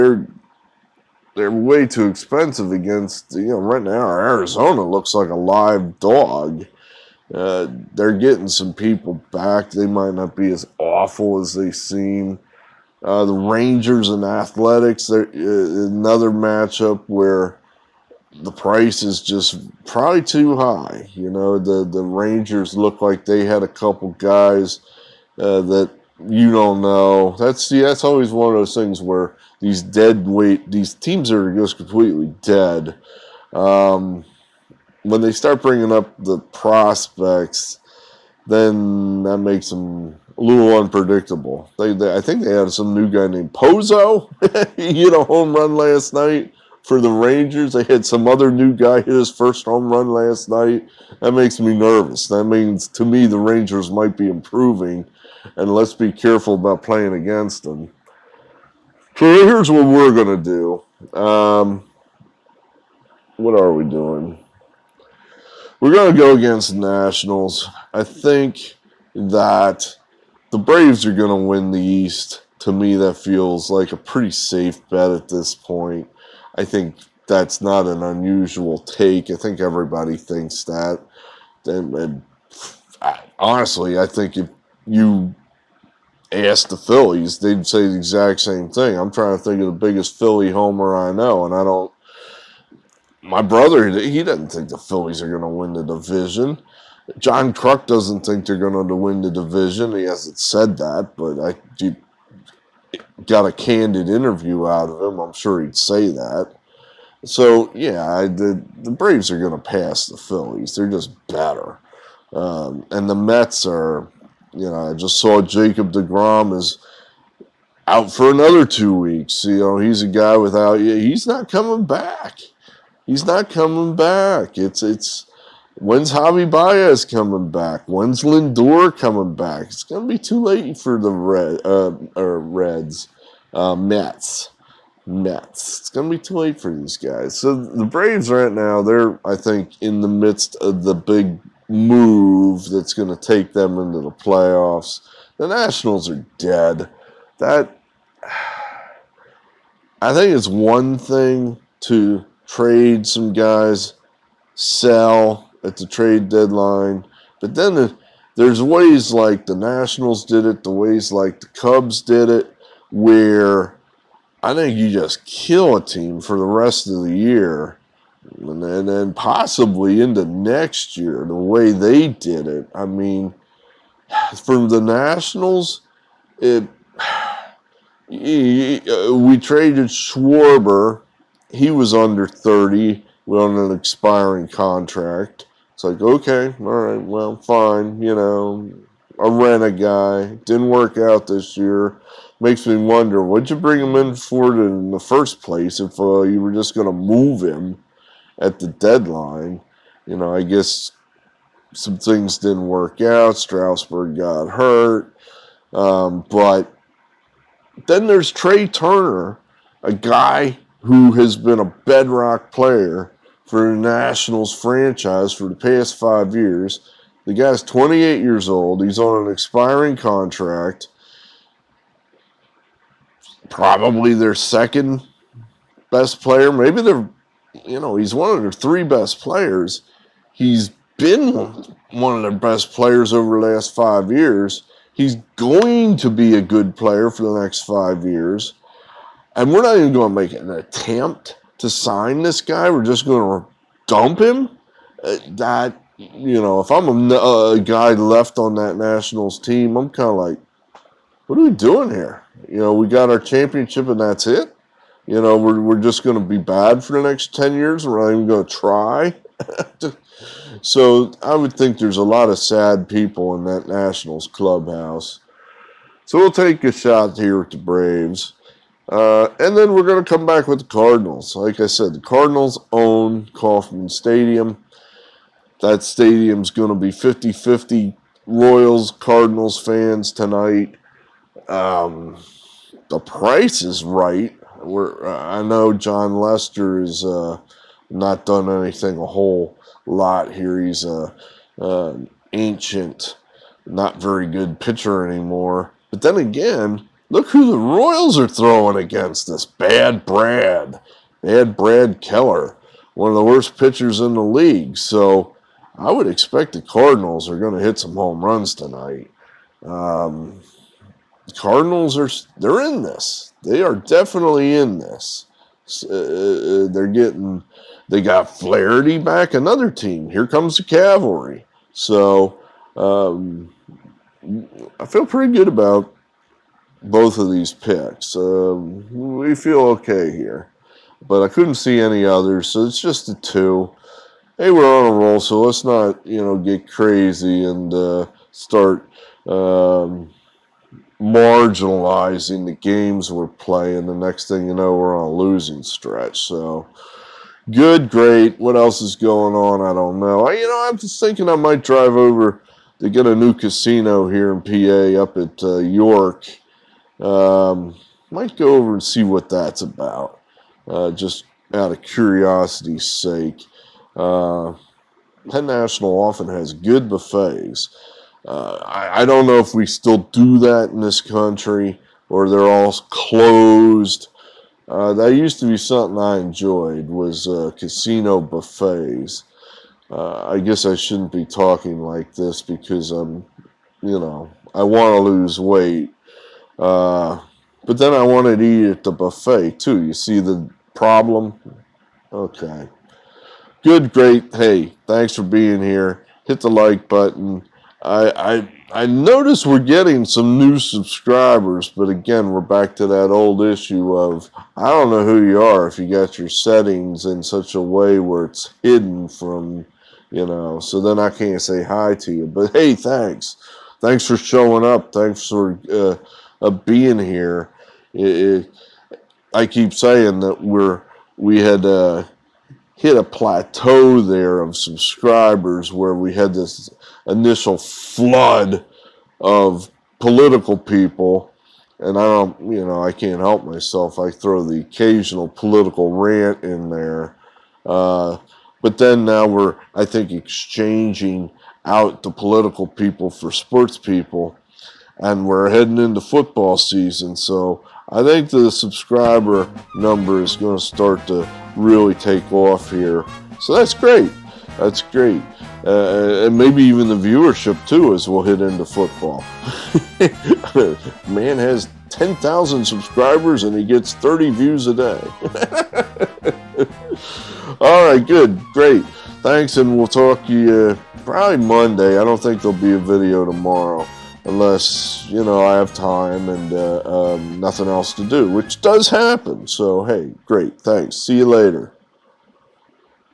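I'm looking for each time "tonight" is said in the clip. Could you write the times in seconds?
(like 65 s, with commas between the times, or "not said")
280 s, 308 s.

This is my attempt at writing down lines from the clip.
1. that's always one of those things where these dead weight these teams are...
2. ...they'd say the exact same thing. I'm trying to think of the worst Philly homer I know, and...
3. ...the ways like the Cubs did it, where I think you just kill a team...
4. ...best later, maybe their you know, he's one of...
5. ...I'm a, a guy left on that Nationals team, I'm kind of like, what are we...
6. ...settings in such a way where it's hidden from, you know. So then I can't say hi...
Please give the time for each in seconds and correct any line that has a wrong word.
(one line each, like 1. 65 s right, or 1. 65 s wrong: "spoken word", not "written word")
1. 27 s right
2. 87 s wrong: "biggest", not "worst"
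3. 160 s right
4. 225 s wrong: "player", not "later"
5. 246 s right
6. 406 s right.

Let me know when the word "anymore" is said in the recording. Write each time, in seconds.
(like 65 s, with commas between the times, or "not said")
295 s.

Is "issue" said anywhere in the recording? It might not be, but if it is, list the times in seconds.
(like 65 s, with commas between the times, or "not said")
403 s.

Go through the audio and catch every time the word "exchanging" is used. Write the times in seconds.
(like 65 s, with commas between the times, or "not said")
440 s.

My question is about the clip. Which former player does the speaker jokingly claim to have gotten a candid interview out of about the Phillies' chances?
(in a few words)
John Kruk.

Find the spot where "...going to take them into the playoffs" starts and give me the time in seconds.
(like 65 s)
142 s.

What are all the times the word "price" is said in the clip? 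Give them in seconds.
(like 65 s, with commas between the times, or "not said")
18 s, 283 s.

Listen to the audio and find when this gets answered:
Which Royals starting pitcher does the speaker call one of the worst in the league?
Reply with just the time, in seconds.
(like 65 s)
301 s.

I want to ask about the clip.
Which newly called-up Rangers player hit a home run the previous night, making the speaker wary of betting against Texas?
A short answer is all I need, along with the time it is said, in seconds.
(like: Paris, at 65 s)
Pozo, at 43 s.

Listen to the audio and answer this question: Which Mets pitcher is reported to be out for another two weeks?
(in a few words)
Jacob DeGrom.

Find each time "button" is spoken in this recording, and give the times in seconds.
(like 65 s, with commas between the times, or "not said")
396 s.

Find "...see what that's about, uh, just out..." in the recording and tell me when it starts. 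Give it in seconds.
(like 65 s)
358 s.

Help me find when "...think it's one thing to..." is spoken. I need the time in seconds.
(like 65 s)
150 s.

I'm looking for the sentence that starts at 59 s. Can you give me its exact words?
So here's what we're going to do.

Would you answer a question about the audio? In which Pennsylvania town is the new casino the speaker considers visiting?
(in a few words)
York.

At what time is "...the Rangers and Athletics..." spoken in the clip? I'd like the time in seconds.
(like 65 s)
13 s.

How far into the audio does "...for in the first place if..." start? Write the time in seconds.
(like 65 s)
194 s.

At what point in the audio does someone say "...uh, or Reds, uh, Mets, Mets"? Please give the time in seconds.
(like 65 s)
131 s.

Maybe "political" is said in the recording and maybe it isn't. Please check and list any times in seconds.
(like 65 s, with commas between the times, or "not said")
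429 s, 435 s, 442 s.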